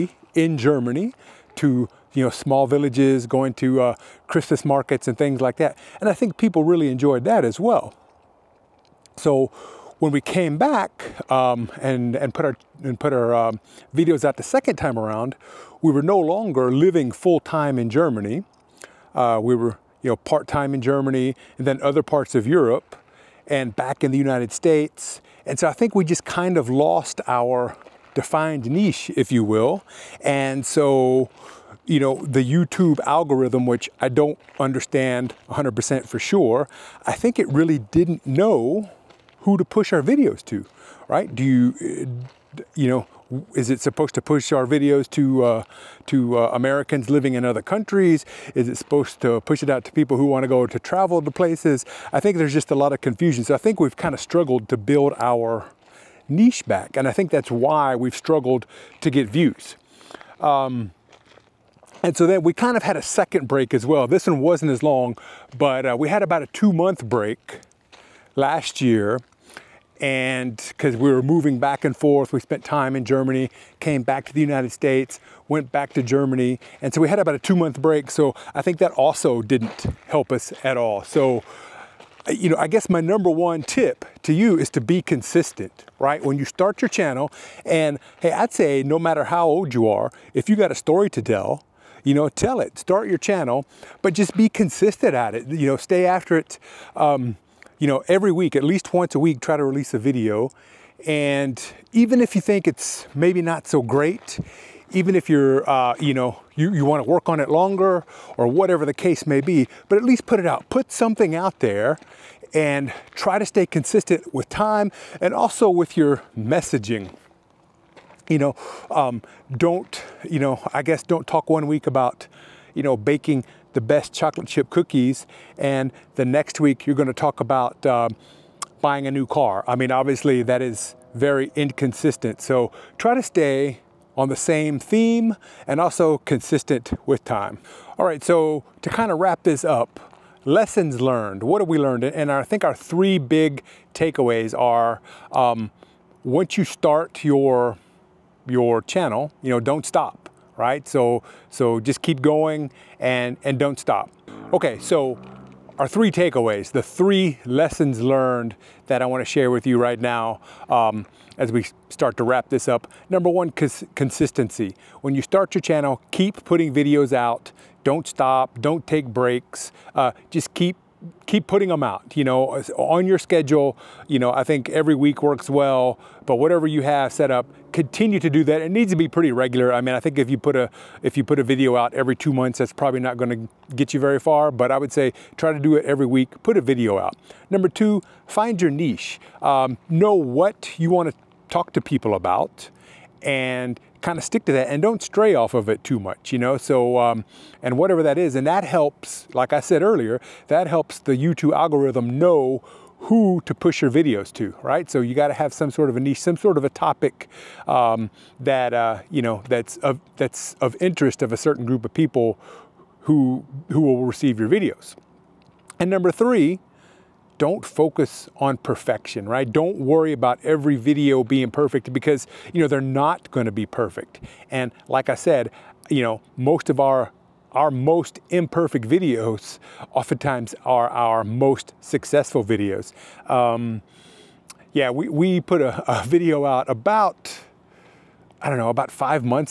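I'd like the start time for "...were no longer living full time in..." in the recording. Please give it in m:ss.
0:15.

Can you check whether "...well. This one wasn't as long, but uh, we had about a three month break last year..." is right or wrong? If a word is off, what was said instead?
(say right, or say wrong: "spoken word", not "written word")
wrong: "two", not "three".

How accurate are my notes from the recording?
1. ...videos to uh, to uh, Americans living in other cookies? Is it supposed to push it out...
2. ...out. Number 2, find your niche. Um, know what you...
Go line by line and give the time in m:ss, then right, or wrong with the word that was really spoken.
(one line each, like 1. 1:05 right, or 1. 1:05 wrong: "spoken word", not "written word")
1. 0:44 wrong: "countries", not "cookies"
2. 3:06 right.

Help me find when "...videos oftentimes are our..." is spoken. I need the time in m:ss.
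3:48.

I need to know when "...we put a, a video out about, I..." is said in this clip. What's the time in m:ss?
3:55.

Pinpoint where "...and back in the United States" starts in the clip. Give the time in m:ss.
0:23.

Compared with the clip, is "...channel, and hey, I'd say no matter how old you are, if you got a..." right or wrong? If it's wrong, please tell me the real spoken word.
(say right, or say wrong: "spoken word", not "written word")
right.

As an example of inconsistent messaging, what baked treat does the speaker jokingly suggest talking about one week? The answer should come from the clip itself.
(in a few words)
chocolate chip cookies.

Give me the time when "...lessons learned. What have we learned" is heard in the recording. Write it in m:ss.
2:20.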